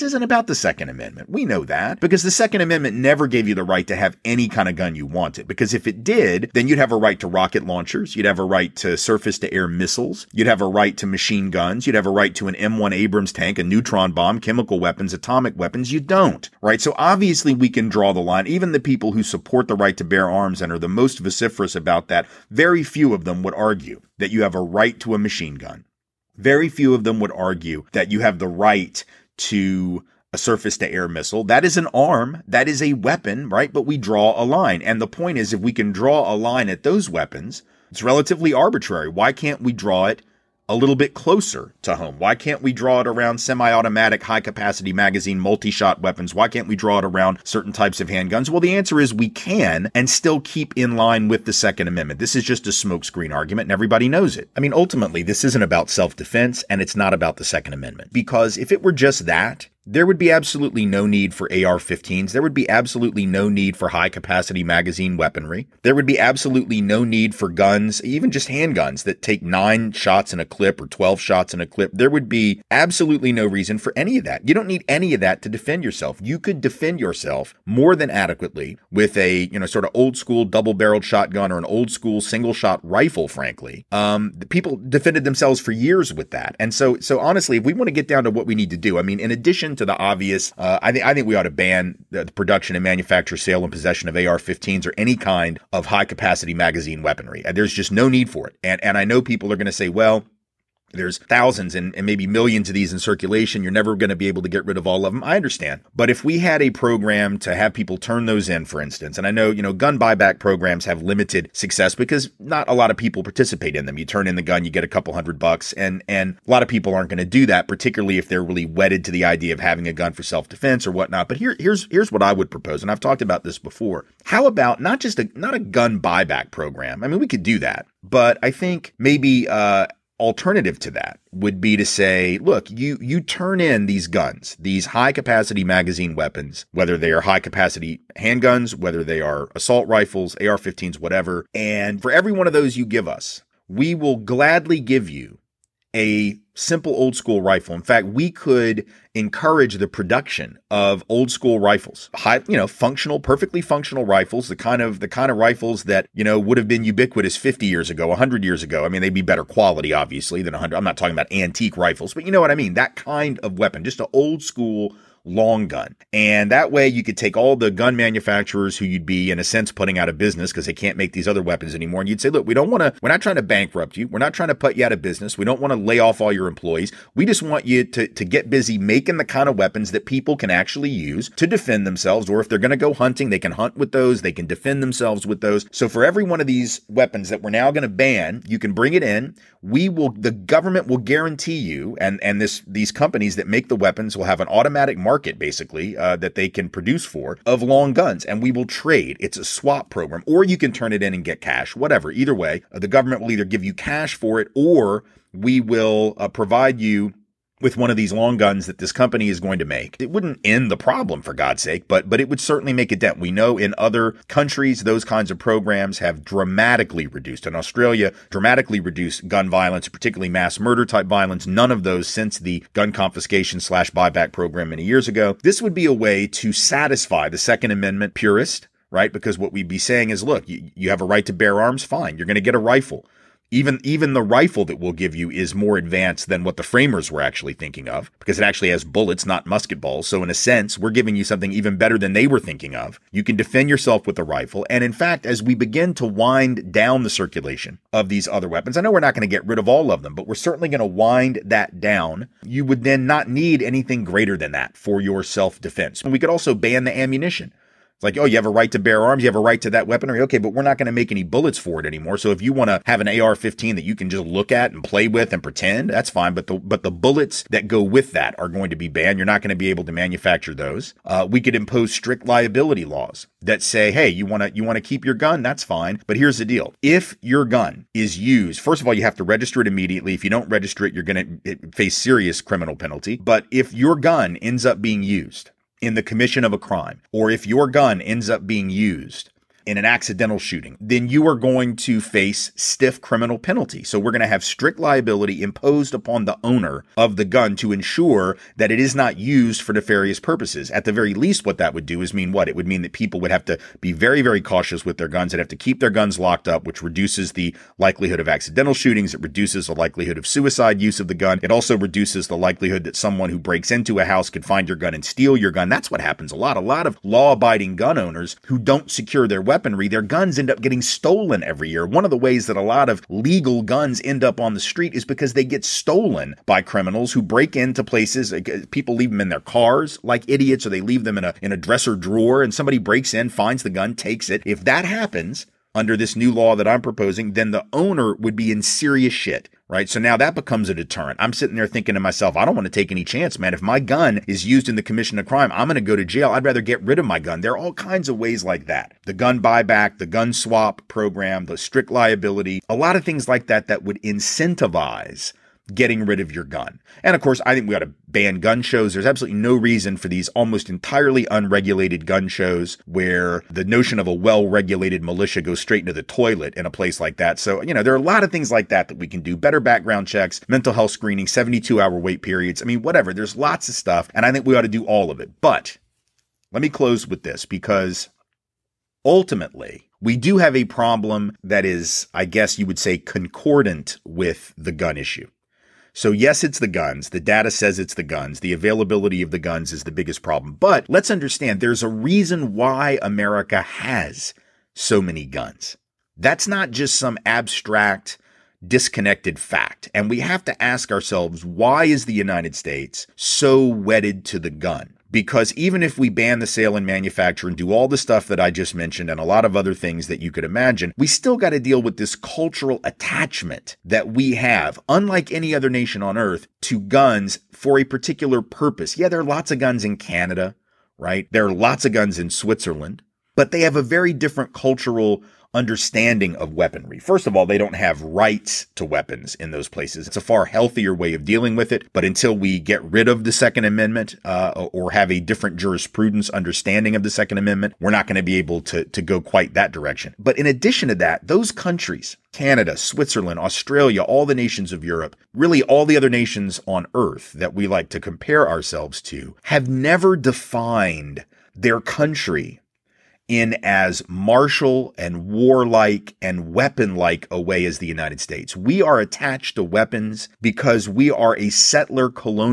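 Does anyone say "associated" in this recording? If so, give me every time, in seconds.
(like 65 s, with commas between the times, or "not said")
not said.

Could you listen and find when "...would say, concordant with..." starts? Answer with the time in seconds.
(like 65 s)
382 s.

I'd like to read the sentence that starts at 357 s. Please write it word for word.
And of course, I think we ought to ban gun shows.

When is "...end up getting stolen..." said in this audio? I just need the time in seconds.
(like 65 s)
320 s.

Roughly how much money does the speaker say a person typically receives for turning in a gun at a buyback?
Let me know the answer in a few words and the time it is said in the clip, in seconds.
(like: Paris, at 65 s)
a couple hundred bucks, at 114 s.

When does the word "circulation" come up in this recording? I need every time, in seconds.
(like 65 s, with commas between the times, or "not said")
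102 s, 247 s.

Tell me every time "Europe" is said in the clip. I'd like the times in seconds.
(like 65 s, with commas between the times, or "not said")
444 s.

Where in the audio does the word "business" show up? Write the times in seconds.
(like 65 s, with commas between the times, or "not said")
170 s, 175 s.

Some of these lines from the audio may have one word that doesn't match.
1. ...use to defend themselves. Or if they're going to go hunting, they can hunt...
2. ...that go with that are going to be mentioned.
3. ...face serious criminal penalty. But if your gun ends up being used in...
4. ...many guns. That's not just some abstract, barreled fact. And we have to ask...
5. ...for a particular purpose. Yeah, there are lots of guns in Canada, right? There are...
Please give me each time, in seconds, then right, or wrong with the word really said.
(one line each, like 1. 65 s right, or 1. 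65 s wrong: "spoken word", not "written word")
1. 180 s right
2. 267 s wrong: "banned", not "mentioned"
3. 281 s right
4. 395 s wrong: "disconnected", not "barreled"
5. 417 s right.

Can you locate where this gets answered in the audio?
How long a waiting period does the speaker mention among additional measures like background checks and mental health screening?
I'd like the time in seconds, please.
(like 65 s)
371 s.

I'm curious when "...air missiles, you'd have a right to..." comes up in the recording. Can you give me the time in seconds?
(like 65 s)
9 s.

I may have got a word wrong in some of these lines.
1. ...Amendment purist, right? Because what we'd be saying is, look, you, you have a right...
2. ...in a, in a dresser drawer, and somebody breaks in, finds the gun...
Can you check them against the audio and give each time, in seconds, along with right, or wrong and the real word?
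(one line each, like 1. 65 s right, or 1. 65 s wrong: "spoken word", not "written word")
1. 227 s right
2. 331 s right.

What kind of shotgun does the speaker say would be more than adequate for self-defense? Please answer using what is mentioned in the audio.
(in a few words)
double barreled shotgun.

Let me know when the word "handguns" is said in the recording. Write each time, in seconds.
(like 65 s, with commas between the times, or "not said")
48 s, 68 s, 138 s.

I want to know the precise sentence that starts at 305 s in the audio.
They'd have to keep their guns locked up, which reduces the likelihood of accidental shootings.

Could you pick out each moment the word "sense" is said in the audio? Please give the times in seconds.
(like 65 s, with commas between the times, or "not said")
169 s, 240 s.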